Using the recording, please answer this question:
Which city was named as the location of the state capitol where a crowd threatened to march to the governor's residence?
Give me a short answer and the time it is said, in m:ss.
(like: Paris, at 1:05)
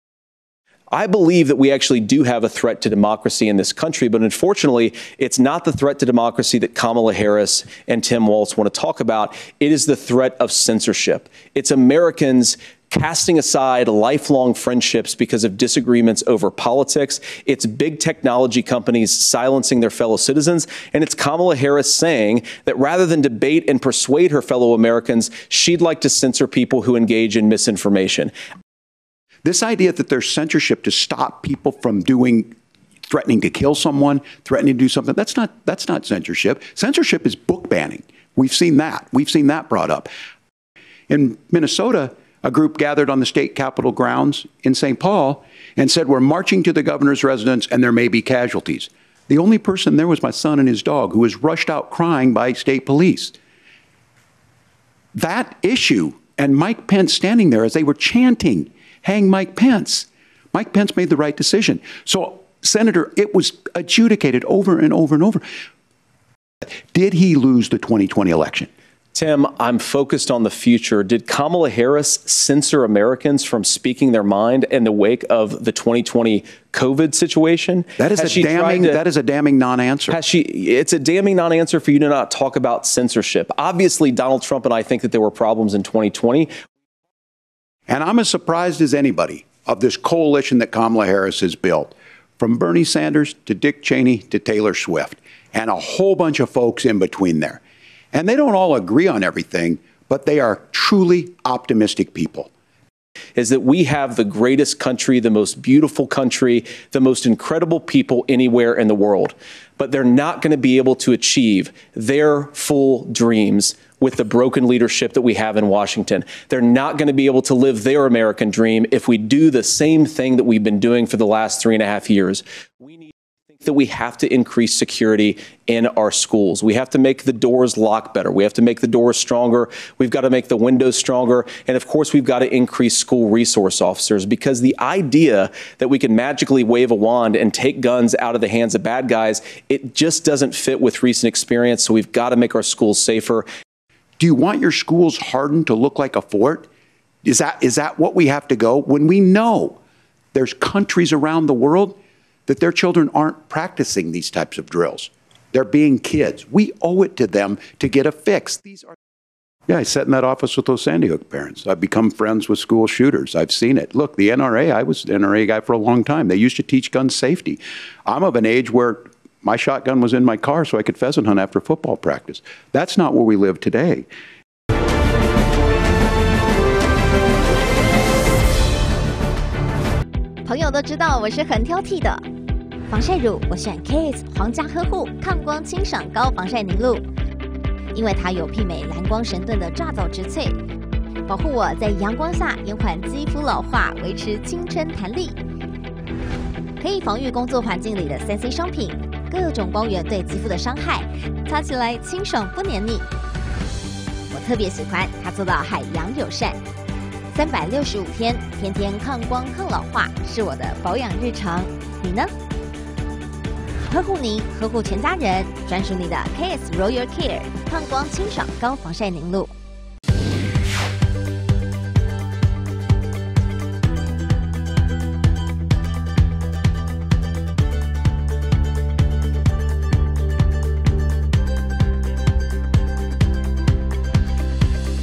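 St. Paul, at 0:44.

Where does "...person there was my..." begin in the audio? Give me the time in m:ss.
0:49.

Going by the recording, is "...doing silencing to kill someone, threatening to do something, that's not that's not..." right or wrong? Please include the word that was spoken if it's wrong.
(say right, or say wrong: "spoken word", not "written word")
wrong: "threatening", not "silencing".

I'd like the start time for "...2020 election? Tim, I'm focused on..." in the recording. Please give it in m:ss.
1:07.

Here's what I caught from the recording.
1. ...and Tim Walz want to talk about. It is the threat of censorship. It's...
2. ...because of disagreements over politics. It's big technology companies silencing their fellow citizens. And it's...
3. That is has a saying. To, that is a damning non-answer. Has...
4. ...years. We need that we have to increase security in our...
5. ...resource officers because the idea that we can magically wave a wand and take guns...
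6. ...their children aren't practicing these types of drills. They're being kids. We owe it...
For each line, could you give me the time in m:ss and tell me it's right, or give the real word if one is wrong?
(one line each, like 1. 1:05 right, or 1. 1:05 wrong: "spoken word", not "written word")
1. 0:07 right
2. 0:15 right
3. 1:17 wrong: "damning", not "saying"
4. 2:02 right
5. 2:13 right
6. 2:32 right.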